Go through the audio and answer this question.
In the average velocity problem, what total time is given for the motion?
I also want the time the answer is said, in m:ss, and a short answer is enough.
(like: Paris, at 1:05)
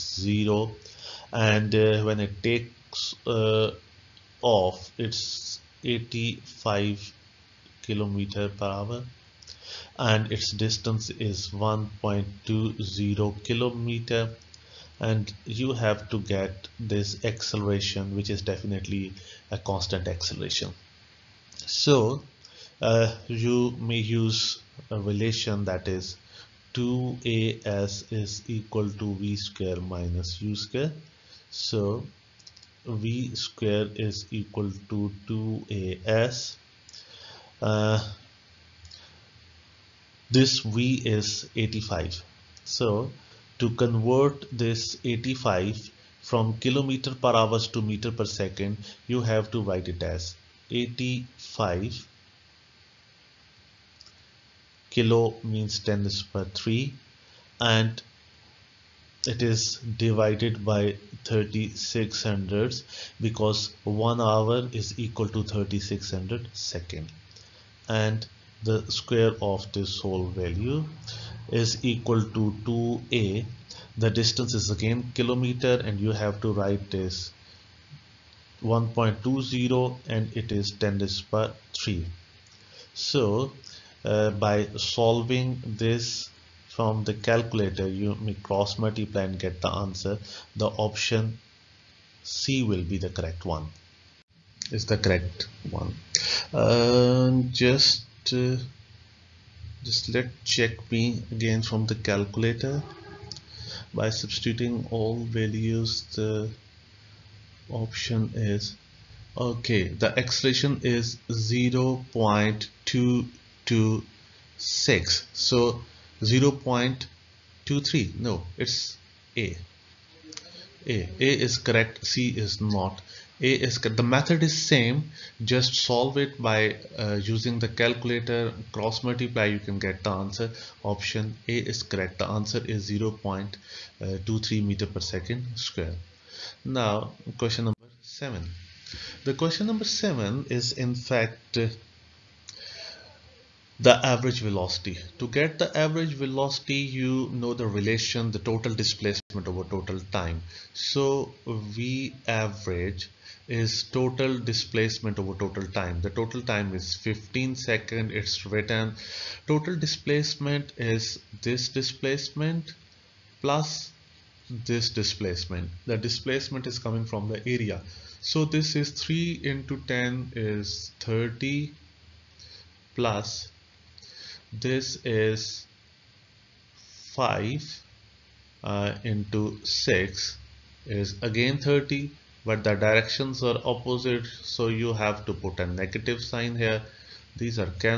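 15 seconds, at 2:36.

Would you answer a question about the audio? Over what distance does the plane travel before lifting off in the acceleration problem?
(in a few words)
1.20 kilometer.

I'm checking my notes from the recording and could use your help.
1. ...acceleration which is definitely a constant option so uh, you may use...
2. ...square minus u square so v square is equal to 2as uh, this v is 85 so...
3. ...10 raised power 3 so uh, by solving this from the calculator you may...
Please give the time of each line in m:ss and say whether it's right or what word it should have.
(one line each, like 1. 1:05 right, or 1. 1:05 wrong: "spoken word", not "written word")
1. 0:17 wrong: "acceleration", not "option"
2. 0:29 right
3. 1:20 right.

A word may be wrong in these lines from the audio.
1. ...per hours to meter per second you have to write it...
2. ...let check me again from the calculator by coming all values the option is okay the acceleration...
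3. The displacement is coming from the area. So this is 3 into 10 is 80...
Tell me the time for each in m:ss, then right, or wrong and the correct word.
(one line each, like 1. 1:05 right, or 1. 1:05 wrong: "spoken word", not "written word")
1. 0:47 right
2. 1:40 wrong: "substituting", not "coming"
3. 2:45 wrong: "30", not "80".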